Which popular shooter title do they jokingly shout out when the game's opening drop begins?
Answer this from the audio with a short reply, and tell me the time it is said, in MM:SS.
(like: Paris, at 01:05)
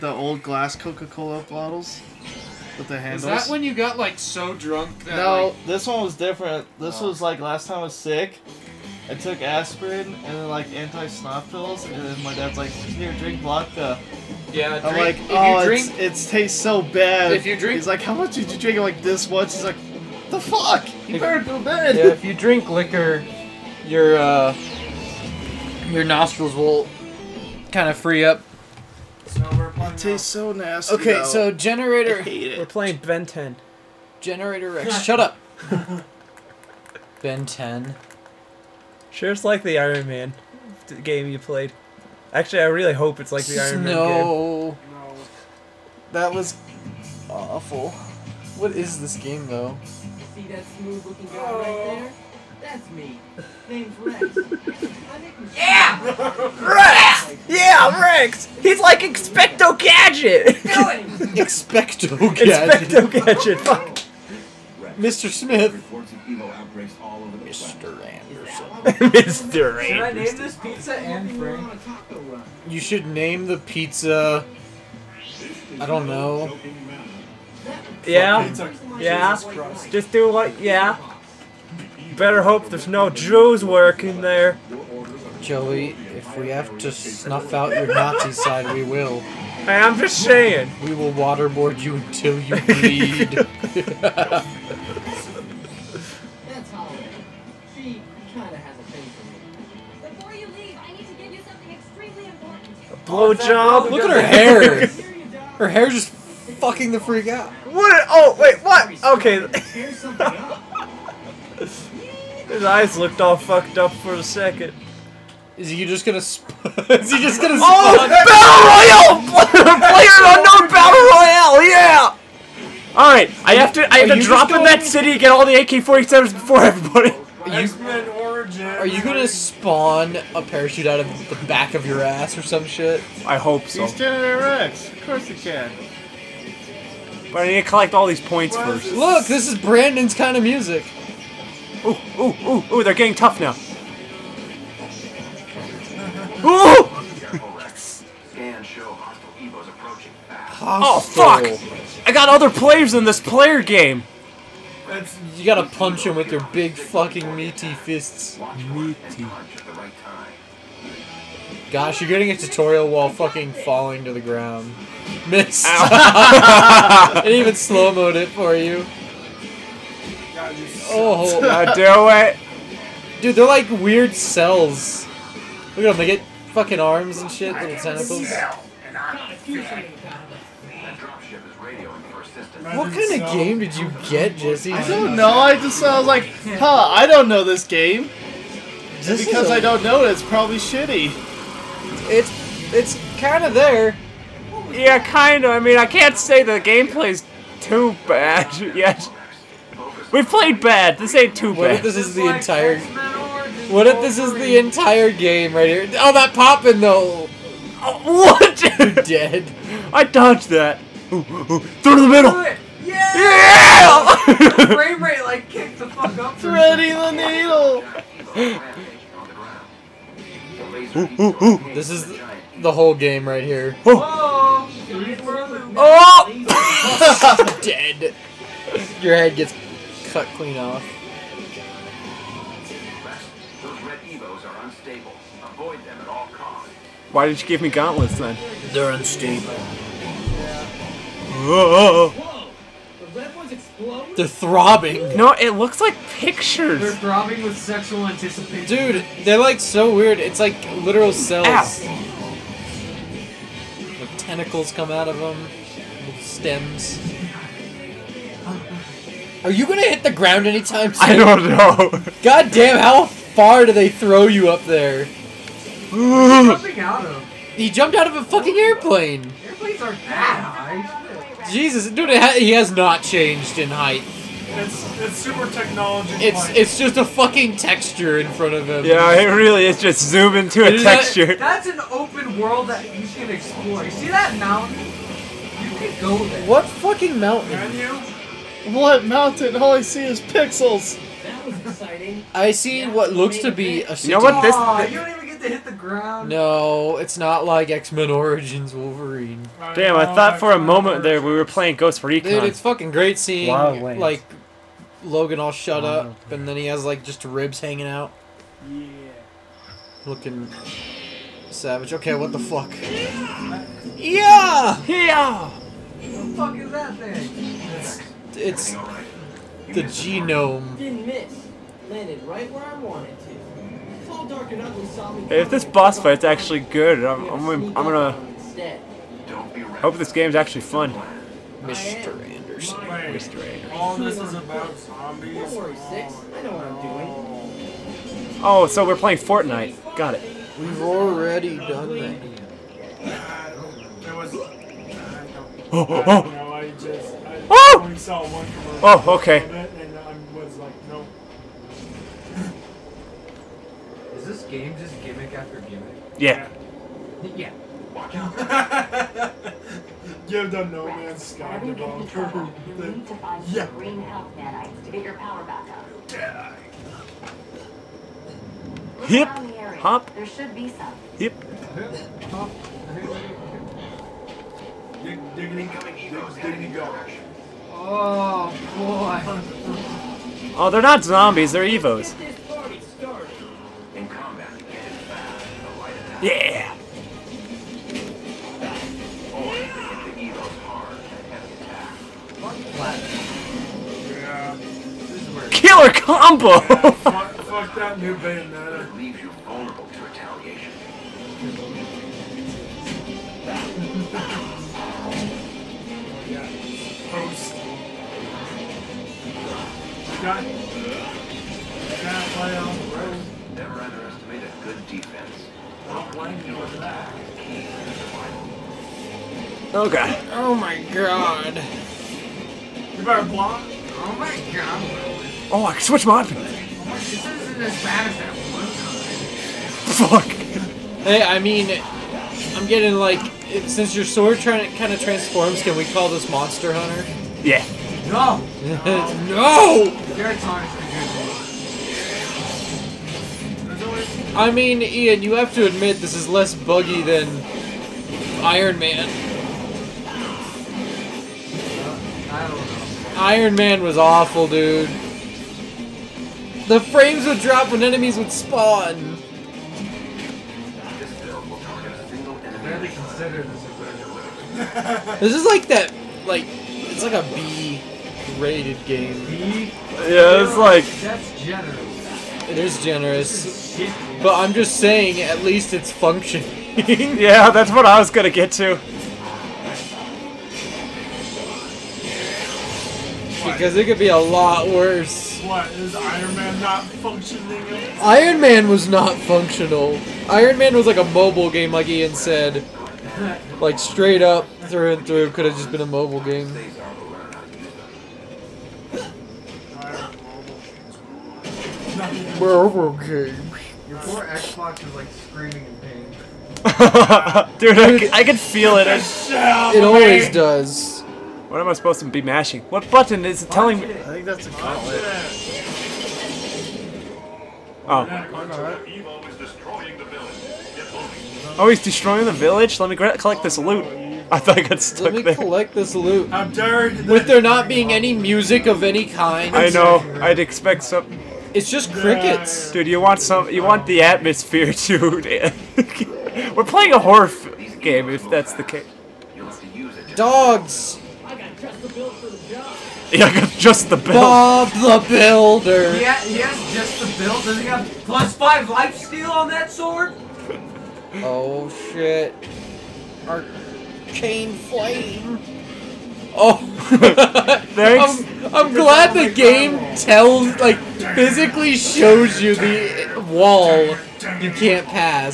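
Player Unknown Battle Royale, at 01:59.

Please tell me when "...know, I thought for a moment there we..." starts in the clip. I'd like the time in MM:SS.
04:59.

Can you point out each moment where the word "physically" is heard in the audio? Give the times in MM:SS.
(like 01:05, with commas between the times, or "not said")
09:21.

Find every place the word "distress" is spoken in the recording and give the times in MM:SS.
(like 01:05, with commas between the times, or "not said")
not said.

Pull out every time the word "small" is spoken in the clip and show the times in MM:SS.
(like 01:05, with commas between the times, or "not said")
not said.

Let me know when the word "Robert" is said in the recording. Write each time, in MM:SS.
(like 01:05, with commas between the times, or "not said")
not said.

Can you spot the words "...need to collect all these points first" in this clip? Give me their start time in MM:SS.
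02:17.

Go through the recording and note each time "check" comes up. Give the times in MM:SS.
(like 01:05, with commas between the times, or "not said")
not said.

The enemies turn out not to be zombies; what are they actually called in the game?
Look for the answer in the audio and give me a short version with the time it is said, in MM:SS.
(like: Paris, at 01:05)
Evos, at 06:21.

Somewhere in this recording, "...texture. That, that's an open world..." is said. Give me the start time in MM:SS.
04:40.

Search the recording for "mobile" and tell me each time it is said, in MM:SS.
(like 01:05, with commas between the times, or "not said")
08:11, 08:15.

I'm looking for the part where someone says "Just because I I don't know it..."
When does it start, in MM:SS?
03:09.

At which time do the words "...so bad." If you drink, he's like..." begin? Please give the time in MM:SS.
00:16.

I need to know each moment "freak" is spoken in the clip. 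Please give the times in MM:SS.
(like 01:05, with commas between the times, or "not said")
01:46.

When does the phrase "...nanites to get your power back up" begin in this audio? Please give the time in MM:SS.
06:04.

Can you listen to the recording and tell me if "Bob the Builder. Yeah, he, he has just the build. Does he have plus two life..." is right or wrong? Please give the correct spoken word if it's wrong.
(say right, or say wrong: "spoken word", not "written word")
wrong: "five", not "two".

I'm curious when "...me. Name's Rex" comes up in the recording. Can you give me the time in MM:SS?
00:52.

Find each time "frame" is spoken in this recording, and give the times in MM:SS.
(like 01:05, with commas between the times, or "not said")
03:34, 07:36.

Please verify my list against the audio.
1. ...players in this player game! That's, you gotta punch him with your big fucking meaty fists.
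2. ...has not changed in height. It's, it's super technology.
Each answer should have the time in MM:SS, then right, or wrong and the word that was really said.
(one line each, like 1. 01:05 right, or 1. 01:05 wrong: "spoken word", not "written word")
1. 02:32 right
2. 04:32 right.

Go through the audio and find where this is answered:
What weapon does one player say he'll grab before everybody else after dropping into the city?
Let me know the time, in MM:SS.
02:05.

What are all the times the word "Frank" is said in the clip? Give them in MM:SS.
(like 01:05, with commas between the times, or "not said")
01:11.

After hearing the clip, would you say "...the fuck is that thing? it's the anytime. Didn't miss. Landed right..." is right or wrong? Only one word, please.
wrong.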